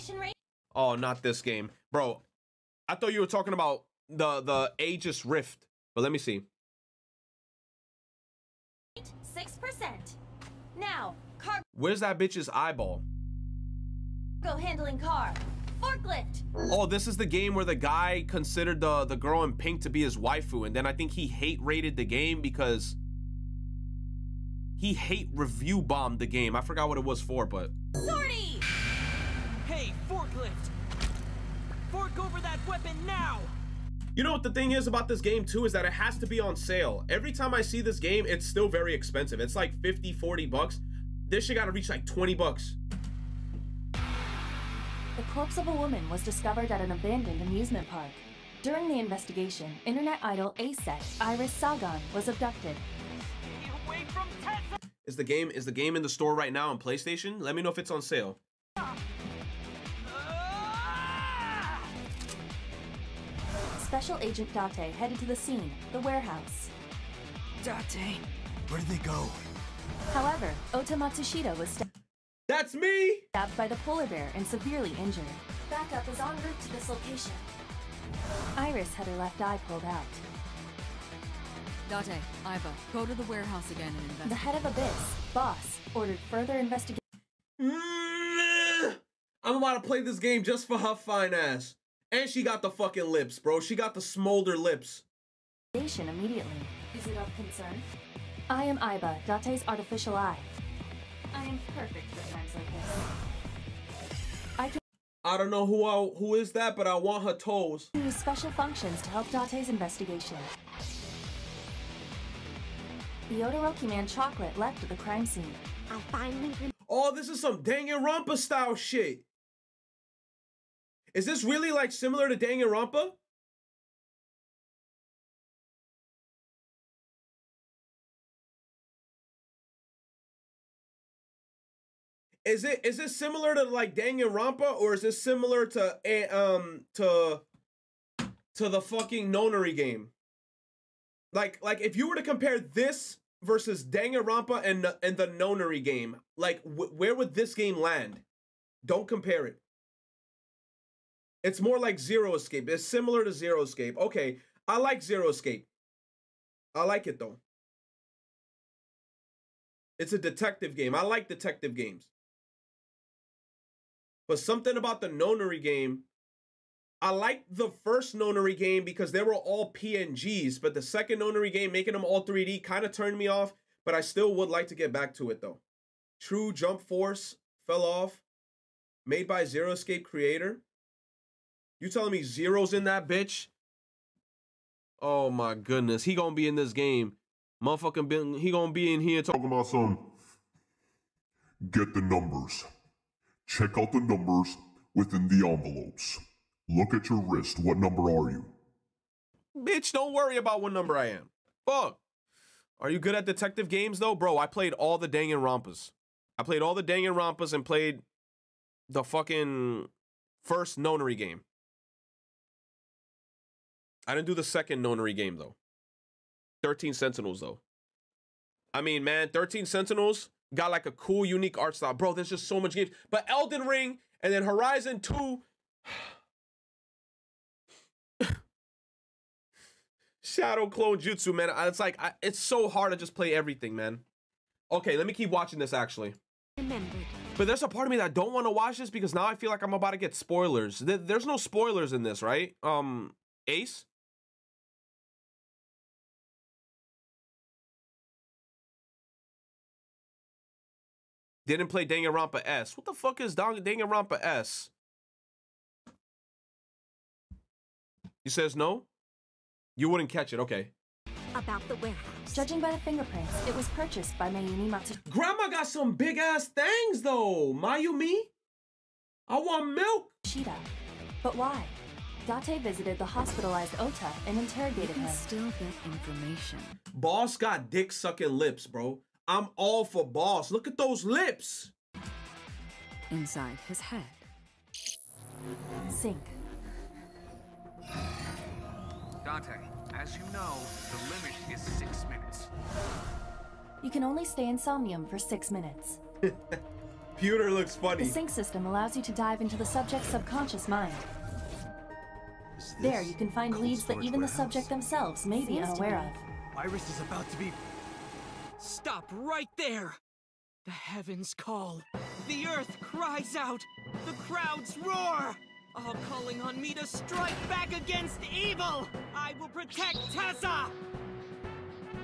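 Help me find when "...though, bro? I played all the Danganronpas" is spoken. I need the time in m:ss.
3:23.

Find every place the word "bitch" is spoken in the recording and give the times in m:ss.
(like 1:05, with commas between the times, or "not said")
0:12, 3:03, 3:19.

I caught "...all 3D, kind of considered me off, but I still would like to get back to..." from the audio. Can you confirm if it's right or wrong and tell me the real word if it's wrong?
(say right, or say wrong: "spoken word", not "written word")
wrong: "turned", not "considered".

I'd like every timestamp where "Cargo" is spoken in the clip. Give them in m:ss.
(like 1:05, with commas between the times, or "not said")
0:14.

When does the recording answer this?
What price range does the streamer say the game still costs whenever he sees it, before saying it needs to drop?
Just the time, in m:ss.
0:39.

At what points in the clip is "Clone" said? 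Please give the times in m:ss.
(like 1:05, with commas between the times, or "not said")
3:50.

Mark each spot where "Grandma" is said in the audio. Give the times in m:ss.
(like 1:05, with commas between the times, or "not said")
4:25.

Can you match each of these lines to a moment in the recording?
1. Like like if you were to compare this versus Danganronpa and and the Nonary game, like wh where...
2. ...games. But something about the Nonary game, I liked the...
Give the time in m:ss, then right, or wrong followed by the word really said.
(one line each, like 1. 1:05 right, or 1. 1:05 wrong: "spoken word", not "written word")
1. 2:21 right
2. 2:41 right.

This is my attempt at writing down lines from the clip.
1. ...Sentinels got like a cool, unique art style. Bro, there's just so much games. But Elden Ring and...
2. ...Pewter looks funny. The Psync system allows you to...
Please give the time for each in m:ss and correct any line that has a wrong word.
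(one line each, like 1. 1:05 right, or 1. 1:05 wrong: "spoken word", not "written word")
1. 3:39 right
2. 4:57 right.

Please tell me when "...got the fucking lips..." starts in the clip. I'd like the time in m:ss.
1:32.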